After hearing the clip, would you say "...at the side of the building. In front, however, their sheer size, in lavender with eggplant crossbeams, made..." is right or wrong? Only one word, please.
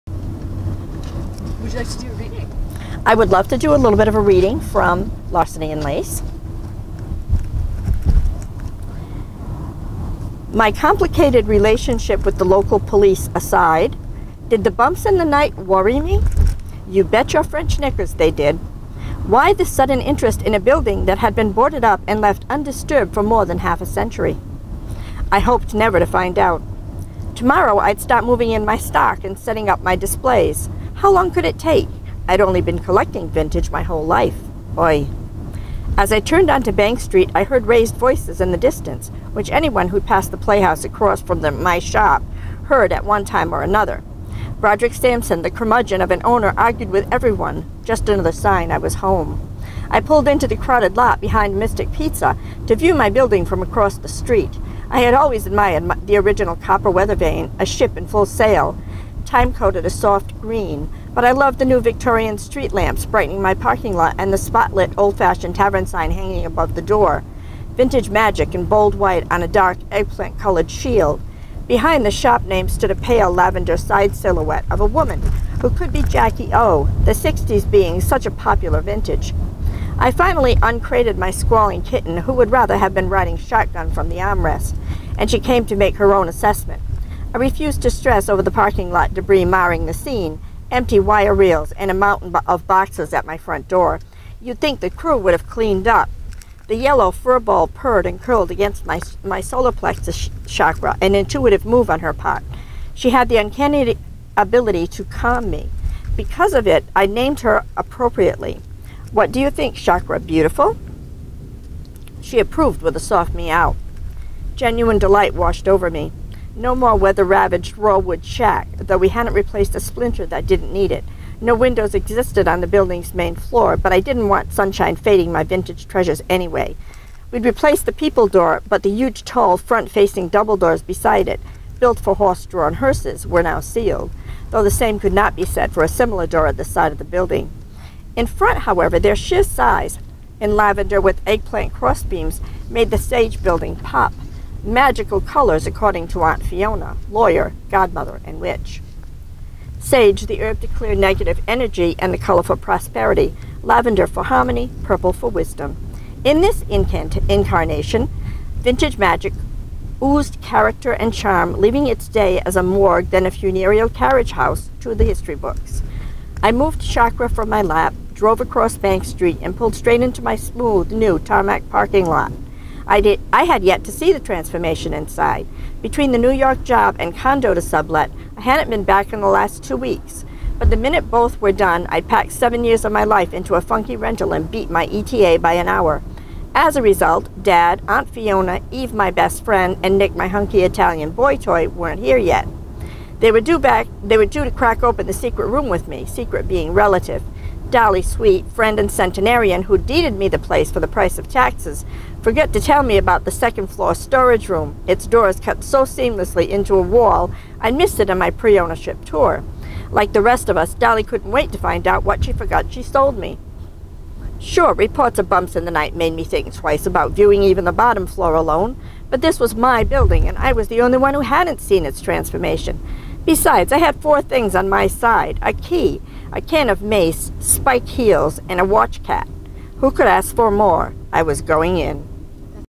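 right.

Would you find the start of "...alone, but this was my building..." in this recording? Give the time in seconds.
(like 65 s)
218 s.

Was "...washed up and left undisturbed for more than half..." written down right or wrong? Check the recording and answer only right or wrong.
wrong.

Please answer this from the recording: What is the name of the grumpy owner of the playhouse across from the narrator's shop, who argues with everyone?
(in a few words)
Broderick Sampson.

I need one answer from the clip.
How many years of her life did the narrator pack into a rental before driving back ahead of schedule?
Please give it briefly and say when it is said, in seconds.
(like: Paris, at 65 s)
7, at 182 s.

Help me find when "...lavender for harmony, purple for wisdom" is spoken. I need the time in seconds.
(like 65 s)
153 s.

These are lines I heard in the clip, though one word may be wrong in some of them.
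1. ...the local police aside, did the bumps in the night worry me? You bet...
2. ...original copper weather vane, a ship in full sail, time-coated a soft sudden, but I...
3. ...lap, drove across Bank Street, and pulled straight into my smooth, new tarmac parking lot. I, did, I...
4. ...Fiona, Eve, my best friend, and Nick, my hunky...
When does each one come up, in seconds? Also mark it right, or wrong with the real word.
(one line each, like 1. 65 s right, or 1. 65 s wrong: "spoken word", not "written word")
1. 12 s right
2. 56 s wrong: "green", not "sudden"
3. 167 s right
4. 188 s right.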